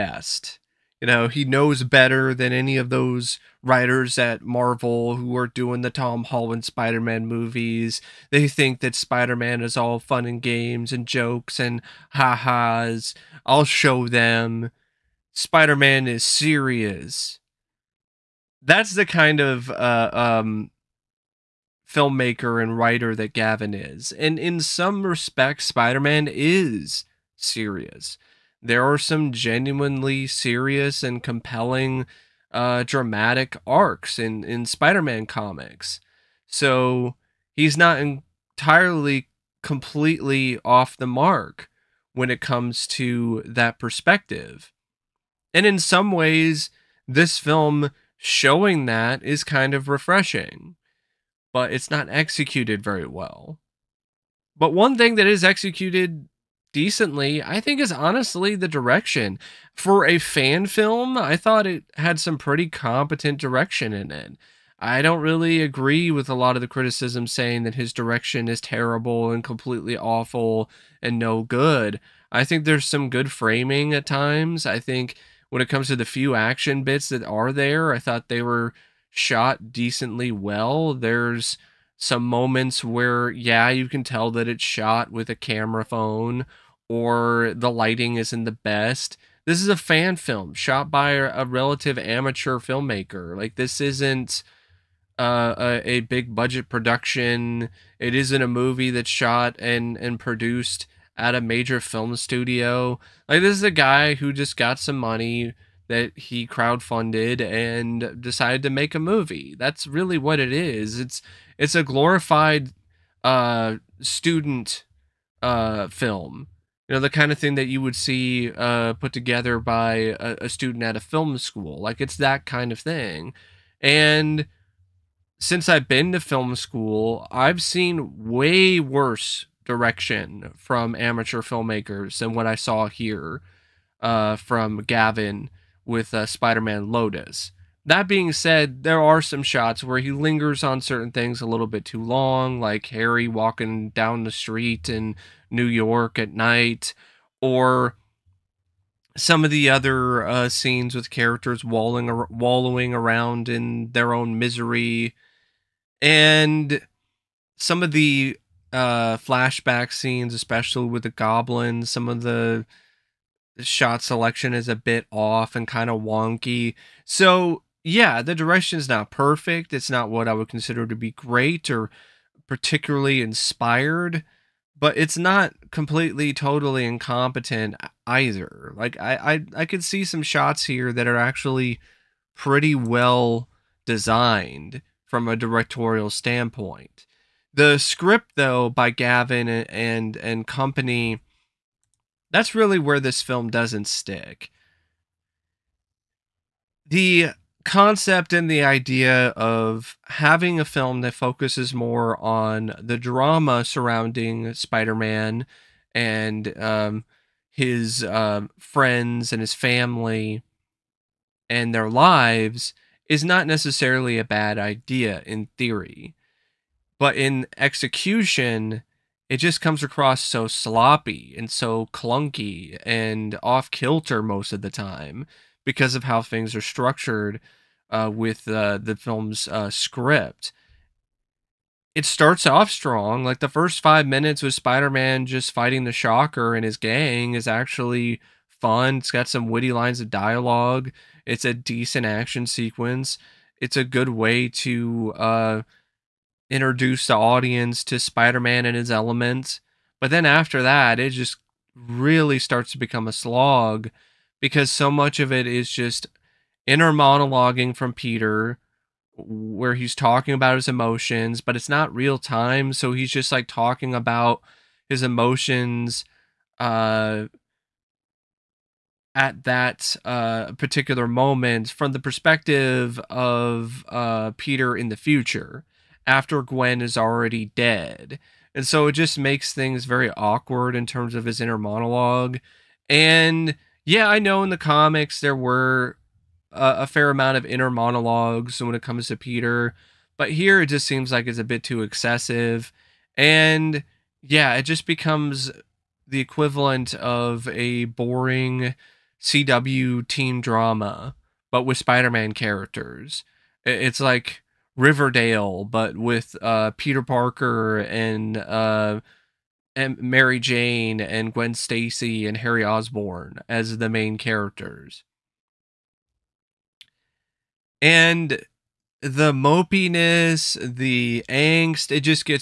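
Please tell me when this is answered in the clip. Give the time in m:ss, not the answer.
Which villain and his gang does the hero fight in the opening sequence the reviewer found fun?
3:55.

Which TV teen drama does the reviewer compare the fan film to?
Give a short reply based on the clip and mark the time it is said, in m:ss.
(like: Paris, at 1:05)
Riverdale, at 5:04.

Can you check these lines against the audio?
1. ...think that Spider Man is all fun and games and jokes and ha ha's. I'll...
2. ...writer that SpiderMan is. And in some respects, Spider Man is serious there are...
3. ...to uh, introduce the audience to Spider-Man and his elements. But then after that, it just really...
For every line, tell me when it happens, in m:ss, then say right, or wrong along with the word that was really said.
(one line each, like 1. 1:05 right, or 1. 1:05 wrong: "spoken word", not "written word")
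1. 0:08 right
2. 0:22 wrong: "Gavin", not "SpiderMan"
3. 4:04 right.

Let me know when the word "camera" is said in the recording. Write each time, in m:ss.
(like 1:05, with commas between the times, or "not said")
1:25.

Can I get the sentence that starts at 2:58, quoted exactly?
Like I I I could see some shots here that are actually pretty well designed from a directorial standpoint.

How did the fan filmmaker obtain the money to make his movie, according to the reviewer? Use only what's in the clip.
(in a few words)
crowdfunded.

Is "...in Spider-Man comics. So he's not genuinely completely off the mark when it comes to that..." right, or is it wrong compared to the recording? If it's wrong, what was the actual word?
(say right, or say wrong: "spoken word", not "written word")
wrong: "entirely", not "genuinely".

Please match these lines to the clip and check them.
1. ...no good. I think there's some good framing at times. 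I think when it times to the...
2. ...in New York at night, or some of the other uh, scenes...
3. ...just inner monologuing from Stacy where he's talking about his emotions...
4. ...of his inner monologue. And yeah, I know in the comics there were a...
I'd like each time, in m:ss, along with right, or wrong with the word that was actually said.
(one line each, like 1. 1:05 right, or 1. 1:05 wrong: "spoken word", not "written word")
1. 1:11 wrong: "comes", not "times"
2. 2:24 right
3. 4:15 wrong: "Peter", not "Stacy"
4. 4:41 right.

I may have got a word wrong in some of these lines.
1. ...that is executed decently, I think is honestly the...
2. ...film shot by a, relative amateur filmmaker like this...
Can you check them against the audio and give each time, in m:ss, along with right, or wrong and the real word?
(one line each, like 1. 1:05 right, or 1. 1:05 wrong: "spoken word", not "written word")
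1. 0:55 right
2. 1:30 right.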